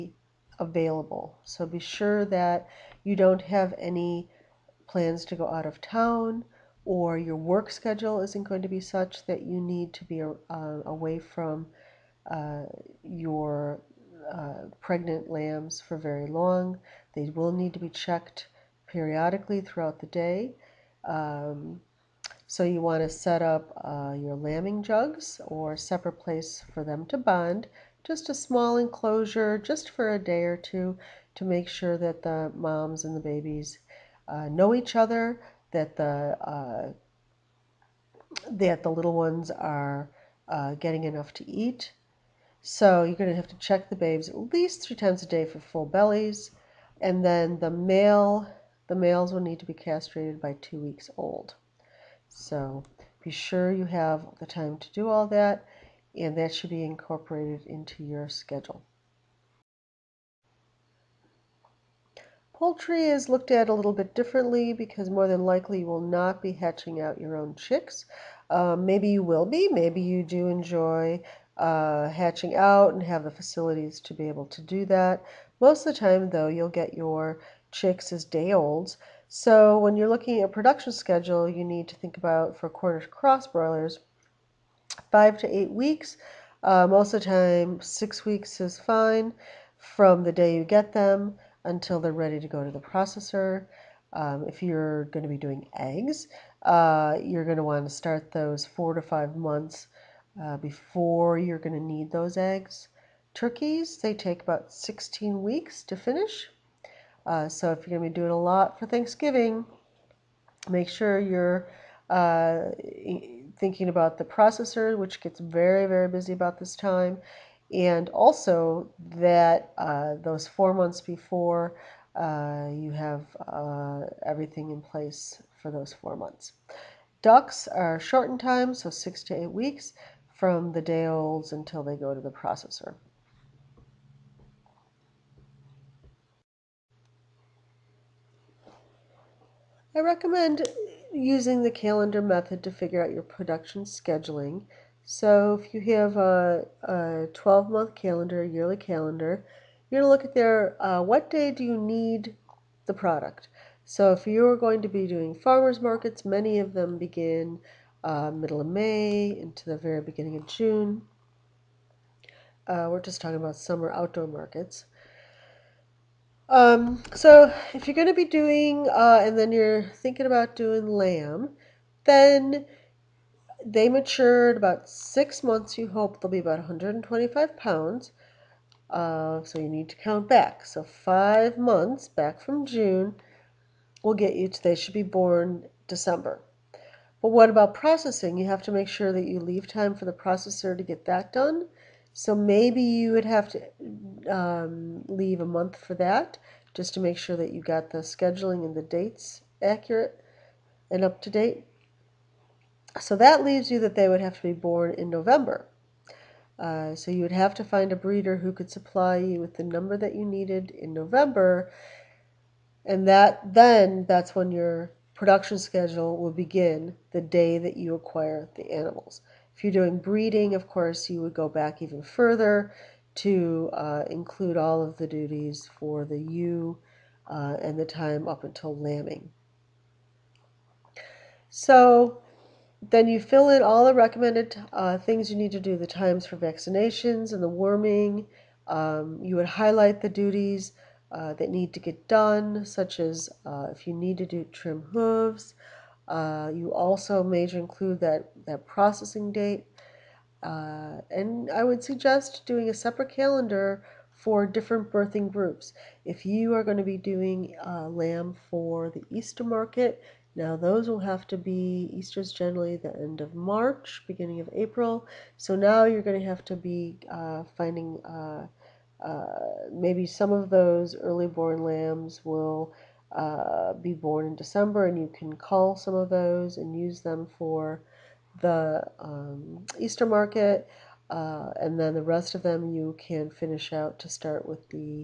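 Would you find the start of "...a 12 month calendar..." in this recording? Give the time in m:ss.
2:26.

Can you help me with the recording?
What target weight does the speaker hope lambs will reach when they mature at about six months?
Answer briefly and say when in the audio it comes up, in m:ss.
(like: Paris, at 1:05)
125 pounds, at 2:56.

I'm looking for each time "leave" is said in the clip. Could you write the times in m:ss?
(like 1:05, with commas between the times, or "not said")
3:09, 3:15, 3:23.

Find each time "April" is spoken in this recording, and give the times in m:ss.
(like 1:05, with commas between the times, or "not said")
4:24.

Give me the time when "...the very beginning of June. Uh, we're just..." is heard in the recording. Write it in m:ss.
2:39.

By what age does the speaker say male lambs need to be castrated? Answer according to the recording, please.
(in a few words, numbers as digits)
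2 weeks old.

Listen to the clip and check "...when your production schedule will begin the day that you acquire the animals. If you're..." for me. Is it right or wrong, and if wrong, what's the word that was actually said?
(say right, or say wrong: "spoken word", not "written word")
right.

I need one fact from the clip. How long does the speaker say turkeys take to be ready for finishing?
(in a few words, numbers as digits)
16 weeks.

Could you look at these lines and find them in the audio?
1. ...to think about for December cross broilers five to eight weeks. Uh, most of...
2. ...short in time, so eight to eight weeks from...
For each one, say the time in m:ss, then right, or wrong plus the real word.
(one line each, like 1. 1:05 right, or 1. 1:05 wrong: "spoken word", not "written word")
1. 1:21 wrong: "Cornish", not "December"
2. 2:07 wrong: "six", not "eight".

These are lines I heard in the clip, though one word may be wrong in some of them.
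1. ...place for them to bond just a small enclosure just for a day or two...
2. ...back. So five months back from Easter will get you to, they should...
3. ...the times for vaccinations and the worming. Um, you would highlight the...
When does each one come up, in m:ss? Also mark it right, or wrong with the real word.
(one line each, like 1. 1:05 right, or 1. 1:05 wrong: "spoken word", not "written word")
1. 0:26 right
2. 3:00 wrong: "June", not "Easter"
3. 3:55 right.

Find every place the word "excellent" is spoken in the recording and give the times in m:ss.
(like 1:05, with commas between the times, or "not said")
not said.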